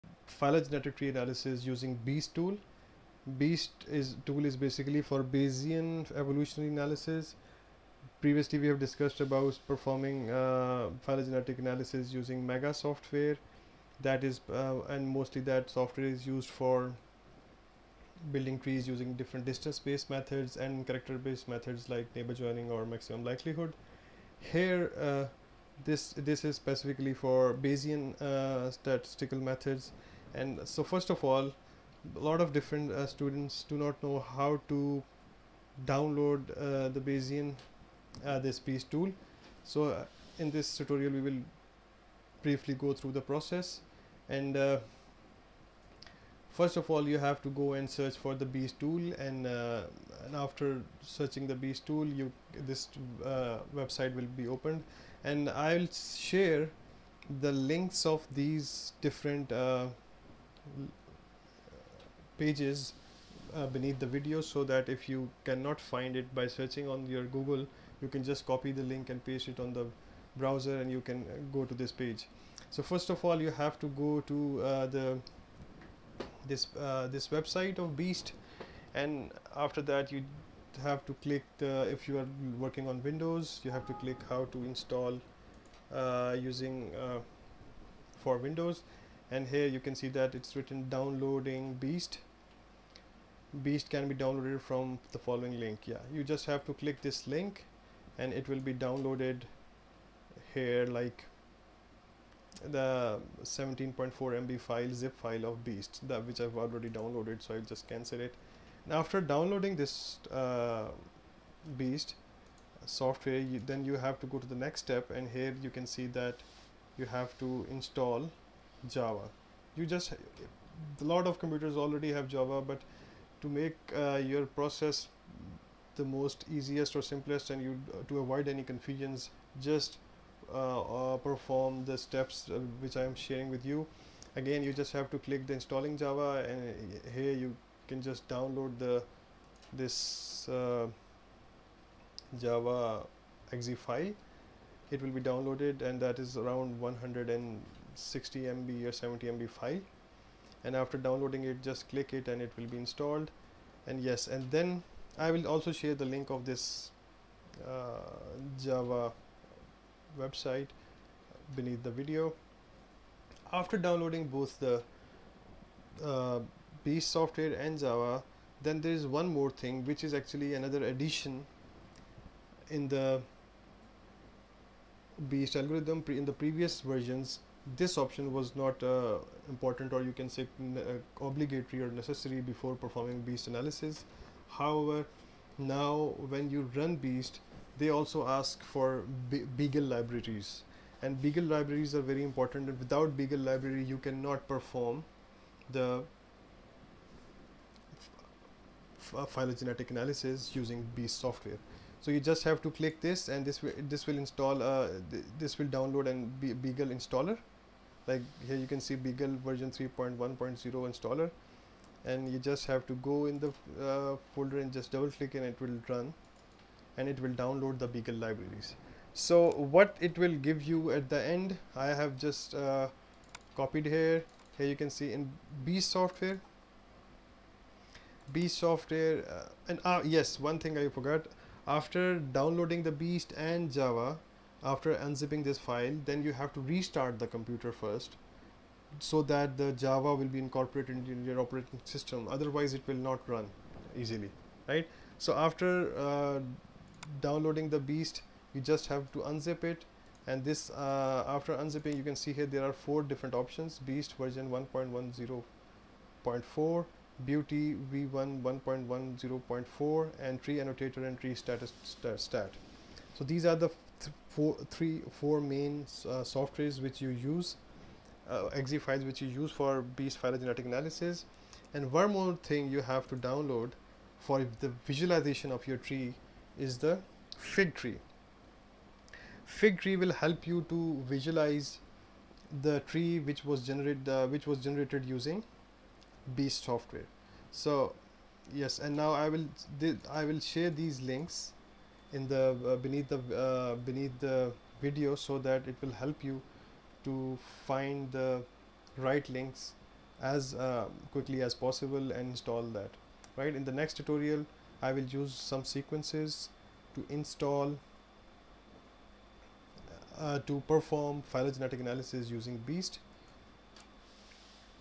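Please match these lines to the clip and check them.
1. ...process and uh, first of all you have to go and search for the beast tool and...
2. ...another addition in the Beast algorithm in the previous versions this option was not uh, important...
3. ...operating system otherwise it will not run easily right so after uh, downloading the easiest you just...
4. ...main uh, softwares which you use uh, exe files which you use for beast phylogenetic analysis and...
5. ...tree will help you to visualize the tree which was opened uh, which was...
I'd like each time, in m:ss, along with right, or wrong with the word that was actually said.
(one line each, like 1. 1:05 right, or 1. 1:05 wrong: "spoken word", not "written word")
1. 0:43 right
2. 2:50 right
3. 4:01 wrong: "beast", not "easiest"
4. 4:25 right
5. 4:39 wrong: "generated", not "opened".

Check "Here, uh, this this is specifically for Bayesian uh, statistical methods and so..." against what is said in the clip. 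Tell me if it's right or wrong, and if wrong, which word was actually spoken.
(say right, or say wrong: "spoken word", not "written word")
right.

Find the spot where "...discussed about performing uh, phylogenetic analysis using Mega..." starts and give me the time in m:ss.
0:08.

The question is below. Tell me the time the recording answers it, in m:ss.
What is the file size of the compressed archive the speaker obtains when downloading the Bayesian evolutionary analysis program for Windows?
1:43.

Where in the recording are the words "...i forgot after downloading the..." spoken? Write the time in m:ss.
3:50.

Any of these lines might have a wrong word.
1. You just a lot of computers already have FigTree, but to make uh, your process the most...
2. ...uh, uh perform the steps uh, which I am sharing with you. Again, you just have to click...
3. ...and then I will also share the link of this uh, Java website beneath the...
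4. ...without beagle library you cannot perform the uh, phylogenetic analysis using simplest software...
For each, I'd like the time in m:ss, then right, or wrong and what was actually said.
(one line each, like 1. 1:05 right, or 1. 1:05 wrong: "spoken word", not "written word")
1. 1:59 wrong: "Java", not "FigTree"
2. 2:10 right
3. 2:34 right
4. 3:12 wrong: "beast", not "simplest".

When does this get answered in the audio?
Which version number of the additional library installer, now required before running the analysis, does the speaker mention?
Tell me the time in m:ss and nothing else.
3:29.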